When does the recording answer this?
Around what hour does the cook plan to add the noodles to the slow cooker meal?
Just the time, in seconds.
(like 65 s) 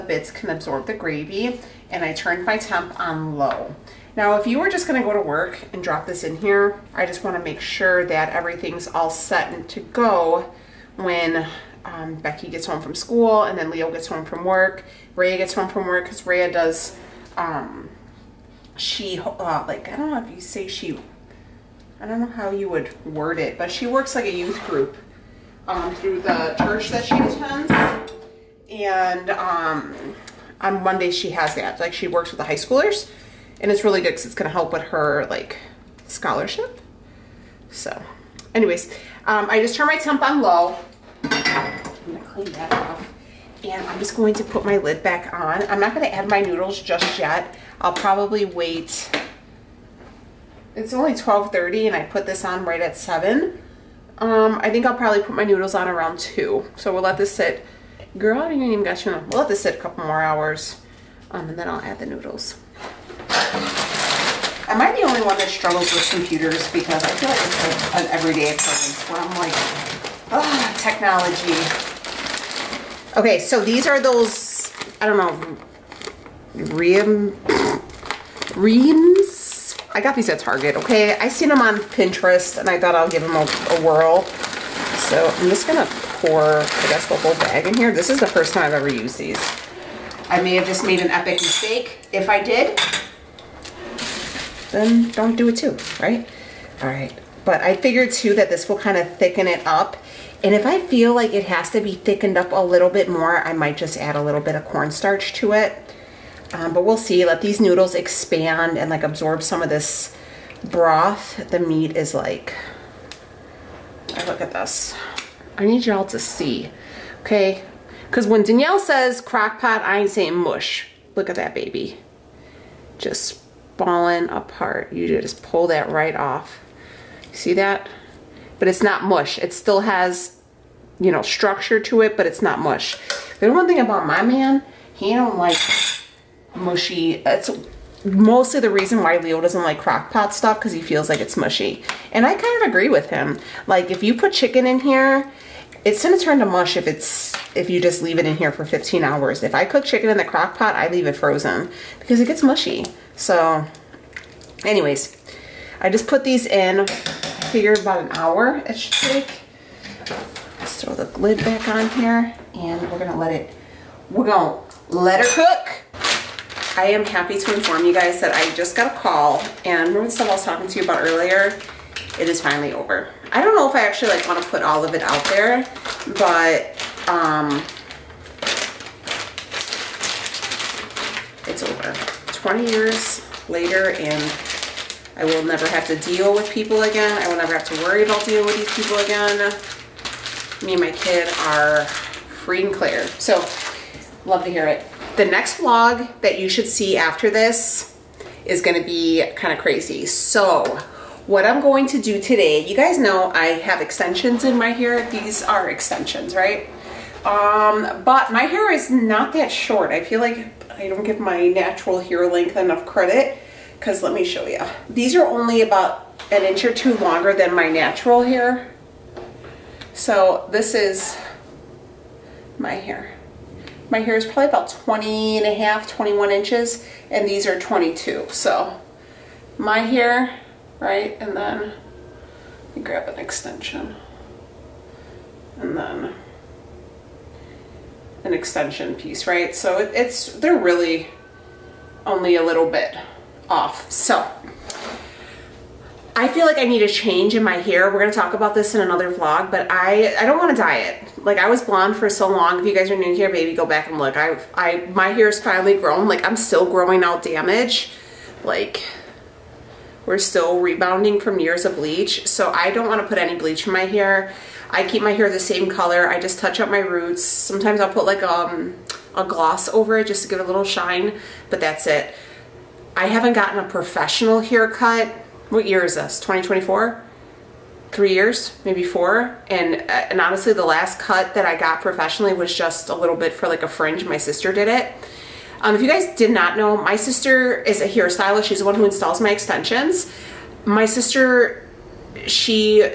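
55 s.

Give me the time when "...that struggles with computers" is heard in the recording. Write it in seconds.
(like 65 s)
65 s.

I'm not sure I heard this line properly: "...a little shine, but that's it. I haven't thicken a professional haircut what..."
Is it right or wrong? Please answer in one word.
wrong.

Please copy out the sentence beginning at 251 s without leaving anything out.
Like I was blonde for so long.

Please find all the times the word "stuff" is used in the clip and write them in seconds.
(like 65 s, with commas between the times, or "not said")
140 s, 170 s.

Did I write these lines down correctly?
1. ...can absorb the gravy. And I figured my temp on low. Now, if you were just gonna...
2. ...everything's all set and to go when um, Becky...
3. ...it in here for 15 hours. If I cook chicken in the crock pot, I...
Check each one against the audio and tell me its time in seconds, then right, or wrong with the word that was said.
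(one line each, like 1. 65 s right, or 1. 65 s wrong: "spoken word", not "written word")
1. 0 s wrong: "turned", not "figured"
2. 8 s right
3. 148 s right.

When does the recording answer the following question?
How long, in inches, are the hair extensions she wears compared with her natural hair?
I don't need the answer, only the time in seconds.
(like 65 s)
227 s.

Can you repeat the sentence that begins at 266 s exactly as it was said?
I just touch up my roots.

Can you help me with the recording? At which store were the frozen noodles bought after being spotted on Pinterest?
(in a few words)
Target.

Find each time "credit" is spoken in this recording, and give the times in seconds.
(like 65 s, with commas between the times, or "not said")
212 s.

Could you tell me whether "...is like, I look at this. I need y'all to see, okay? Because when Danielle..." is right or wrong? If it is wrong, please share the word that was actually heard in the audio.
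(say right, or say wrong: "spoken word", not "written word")
right.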